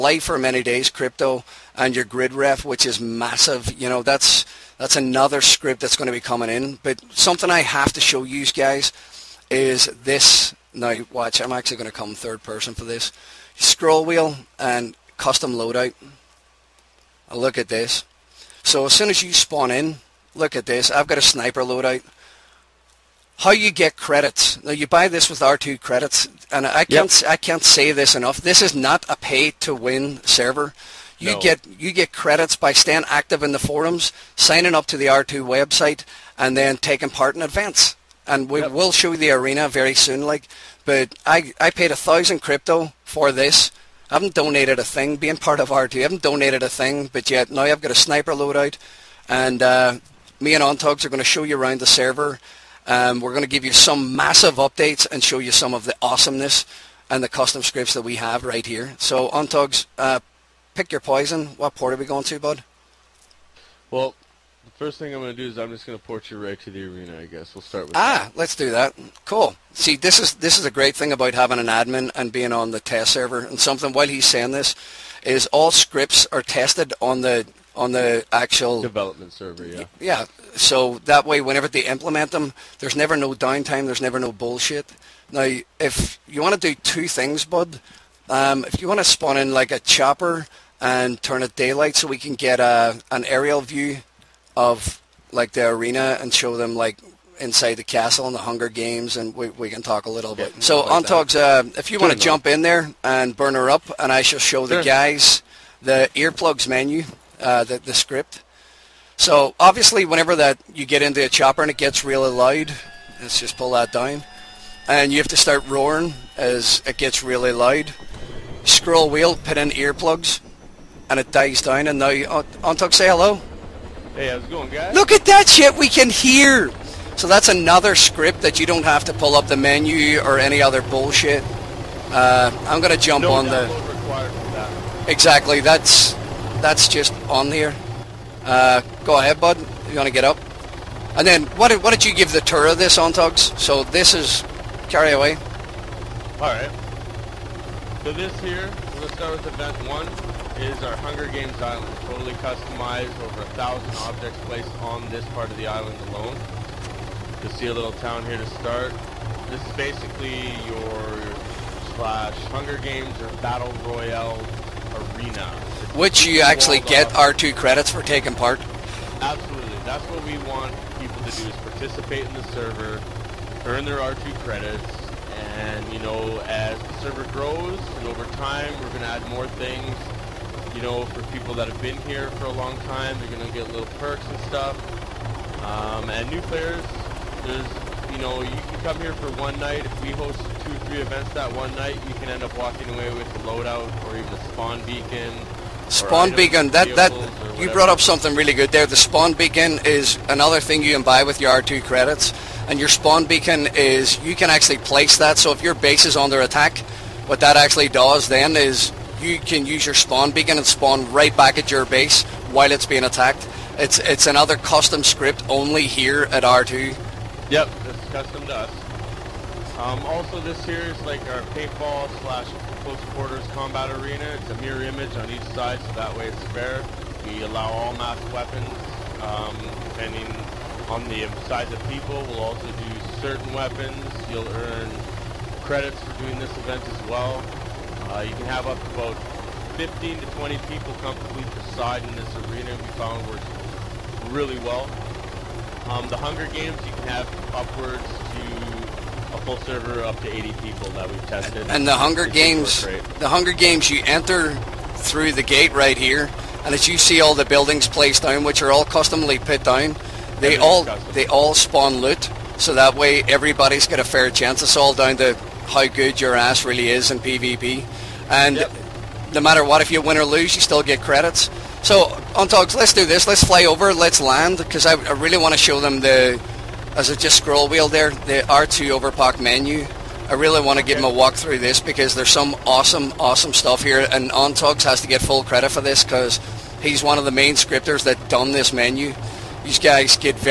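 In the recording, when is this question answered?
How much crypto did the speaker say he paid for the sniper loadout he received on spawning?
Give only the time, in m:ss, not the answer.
0:41.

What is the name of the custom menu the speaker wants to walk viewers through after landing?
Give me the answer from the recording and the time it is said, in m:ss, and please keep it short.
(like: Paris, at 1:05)
R2 Overpoch menu, at 4:38.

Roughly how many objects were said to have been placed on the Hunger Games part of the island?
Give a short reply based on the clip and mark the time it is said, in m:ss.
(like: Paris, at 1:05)
over 1000, at 2:33.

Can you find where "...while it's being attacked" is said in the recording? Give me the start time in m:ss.
3:32.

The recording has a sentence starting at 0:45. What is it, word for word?
Being part of R2, I haven't donated a thing.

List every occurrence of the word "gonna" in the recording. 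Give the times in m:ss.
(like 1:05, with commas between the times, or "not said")
2:12, 2:28.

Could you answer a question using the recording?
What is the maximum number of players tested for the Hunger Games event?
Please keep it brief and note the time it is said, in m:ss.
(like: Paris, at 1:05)
80, at 4:10.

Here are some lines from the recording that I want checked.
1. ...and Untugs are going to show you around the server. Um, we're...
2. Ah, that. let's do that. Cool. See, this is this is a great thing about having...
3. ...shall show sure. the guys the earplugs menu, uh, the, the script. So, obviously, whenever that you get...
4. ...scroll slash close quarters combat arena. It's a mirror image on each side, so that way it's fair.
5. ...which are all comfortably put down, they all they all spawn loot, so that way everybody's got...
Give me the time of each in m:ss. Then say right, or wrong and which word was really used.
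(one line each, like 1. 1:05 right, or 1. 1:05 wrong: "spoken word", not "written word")
1. 0:50 right
2. 1:07 right
3. 1:44 right
4. 3:41 wrong: "paintball", not "scroll"
5. 4:18 wrong: "customly", not "comfortably".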